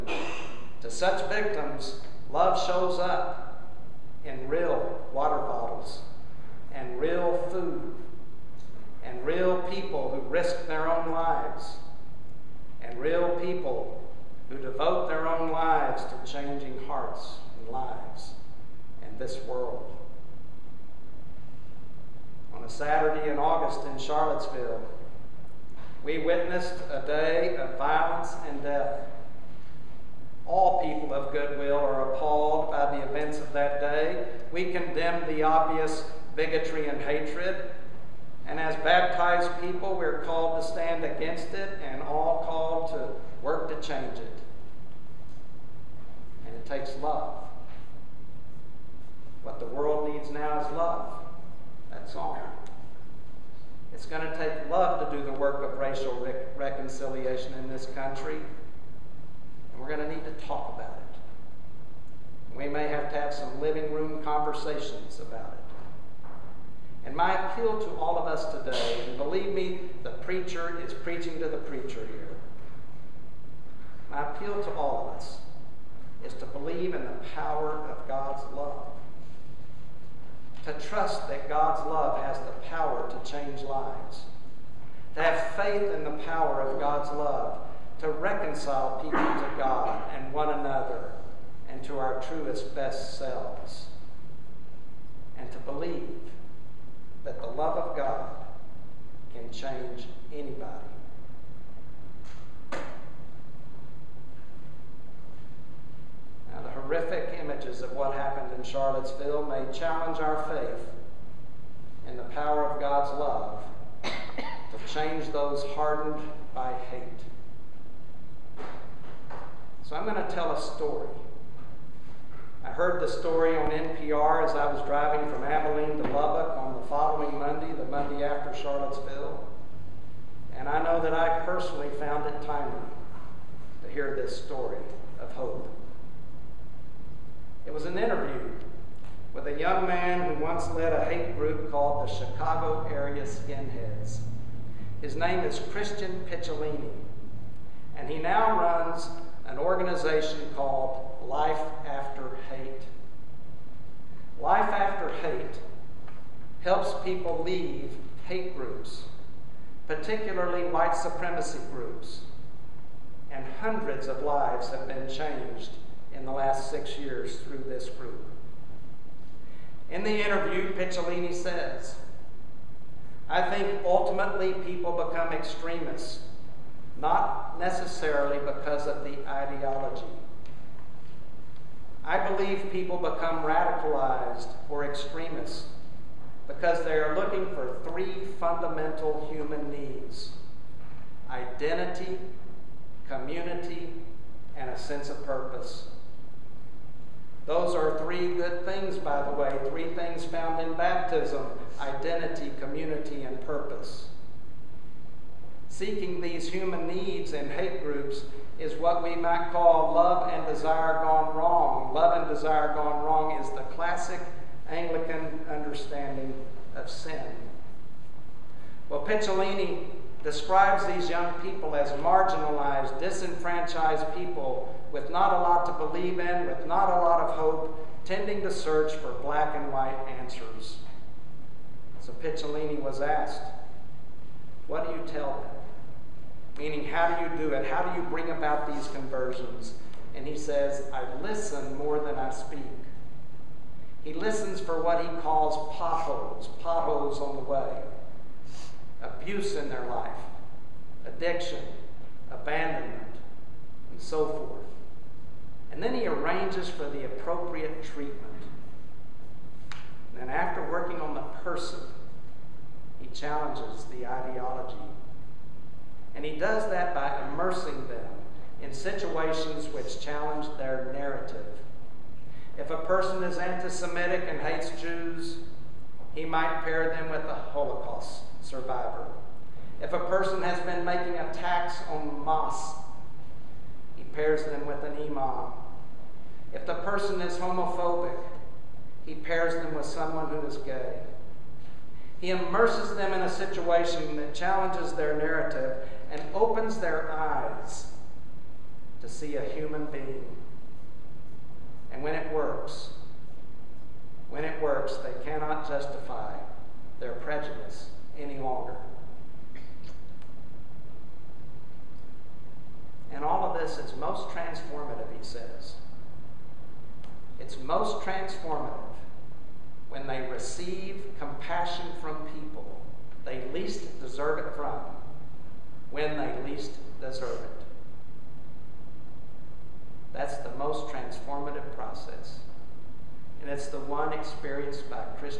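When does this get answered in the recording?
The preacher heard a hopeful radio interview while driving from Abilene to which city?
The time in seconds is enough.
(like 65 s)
126 s.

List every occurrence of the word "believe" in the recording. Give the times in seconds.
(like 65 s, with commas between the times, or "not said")
69 s, 76 s, 95 s, 182 s, 225 s.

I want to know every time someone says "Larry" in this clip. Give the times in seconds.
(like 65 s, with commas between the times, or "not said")
not said.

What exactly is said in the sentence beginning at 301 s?
And when it works, when it works, they cannot justify their prejudice any longer.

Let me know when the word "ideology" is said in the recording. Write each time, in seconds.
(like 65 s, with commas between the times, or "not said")
179 s, 264 s.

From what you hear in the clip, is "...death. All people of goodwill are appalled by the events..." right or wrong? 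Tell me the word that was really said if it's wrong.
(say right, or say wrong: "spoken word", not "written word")
right.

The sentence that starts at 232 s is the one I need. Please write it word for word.
So Picciolini was asked, What do you tell them?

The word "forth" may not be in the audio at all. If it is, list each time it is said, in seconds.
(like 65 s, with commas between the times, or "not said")
254 s.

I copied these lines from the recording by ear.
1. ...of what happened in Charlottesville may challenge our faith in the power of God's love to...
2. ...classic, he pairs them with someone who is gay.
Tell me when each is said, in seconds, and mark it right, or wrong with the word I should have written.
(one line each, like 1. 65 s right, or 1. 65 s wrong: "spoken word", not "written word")
1. 107 s right
2. 287 s wrong: "homophobic", not "classic".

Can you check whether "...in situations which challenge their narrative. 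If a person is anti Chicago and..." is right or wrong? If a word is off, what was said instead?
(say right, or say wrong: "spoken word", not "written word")
wrong: "Semitic", not "Chicago".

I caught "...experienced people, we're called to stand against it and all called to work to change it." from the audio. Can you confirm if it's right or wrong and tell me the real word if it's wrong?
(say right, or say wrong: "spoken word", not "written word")
wrong: "baptized", not "experienced".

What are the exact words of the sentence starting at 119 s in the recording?
So I'm going to tell a story.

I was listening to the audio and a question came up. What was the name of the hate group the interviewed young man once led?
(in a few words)
Chicago Area Skinheads.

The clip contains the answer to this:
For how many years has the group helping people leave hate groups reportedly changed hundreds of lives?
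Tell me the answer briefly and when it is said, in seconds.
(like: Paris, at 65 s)
6, at 166 s.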